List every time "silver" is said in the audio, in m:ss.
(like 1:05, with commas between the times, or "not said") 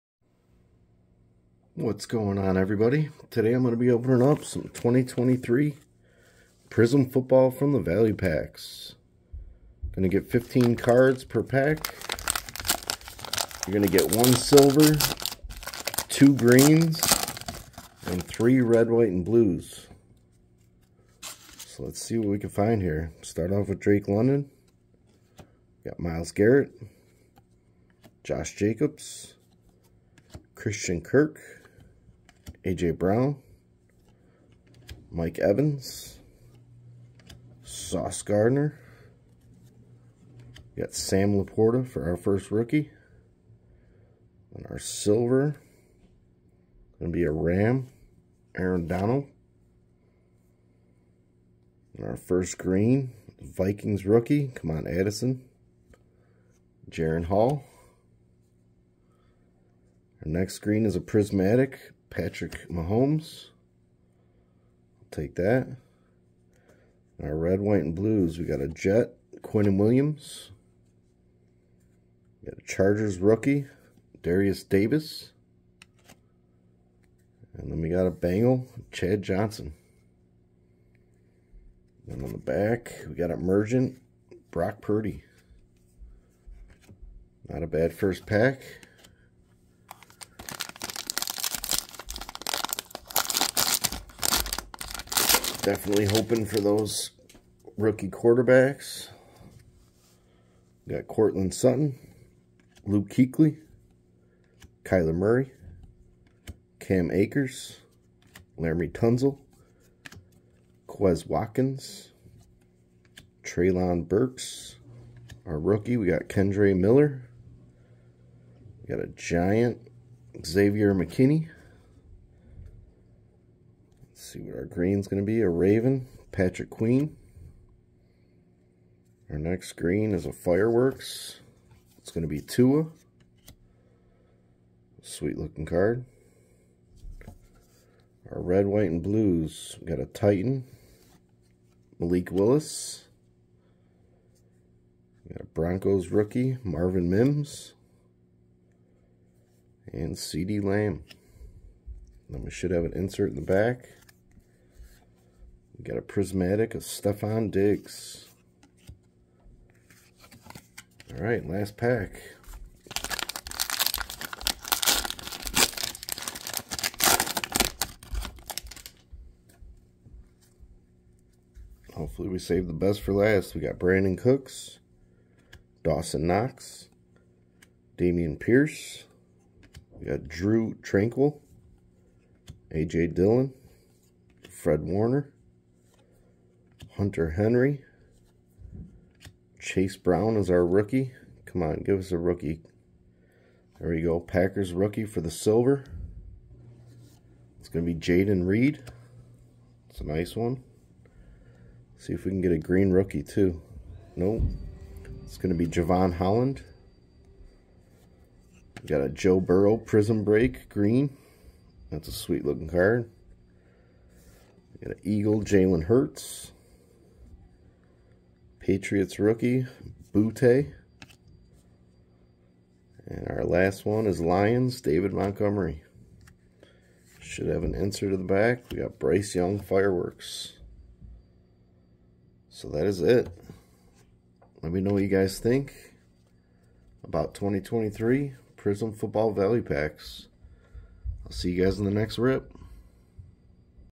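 0:14, 0:44, 3:15.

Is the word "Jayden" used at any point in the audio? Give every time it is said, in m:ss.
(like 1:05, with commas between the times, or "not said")
3:17.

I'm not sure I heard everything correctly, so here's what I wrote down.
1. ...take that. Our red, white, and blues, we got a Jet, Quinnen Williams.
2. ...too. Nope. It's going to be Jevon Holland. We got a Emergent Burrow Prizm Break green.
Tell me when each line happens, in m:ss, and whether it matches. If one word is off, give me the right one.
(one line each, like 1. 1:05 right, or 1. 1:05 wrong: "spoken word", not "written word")
1. 1:05 right
2. 3:23 wrong: "Joe", not "Emergent".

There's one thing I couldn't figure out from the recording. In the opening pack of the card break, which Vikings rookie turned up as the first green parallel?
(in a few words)
Jaren Hall.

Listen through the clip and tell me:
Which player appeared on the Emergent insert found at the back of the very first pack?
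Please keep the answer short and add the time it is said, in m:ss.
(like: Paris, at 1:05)
Brock Purdy, at 1:24.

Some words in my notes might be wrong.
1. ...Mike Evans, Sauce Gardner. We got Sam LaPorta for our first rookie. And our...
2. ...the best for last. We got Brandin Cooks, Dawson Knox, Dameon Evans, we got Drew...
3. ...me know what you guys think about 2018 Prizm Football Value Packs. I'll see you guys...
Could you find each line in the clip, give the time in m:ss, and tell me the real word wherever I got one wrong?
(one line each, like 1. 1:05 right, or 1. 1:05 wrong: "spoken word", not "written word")
1. 0:35 right
2. 2:52 wrong: "Pierce", not "Evans"
3. 3:54 wrong: "2023", not "2018".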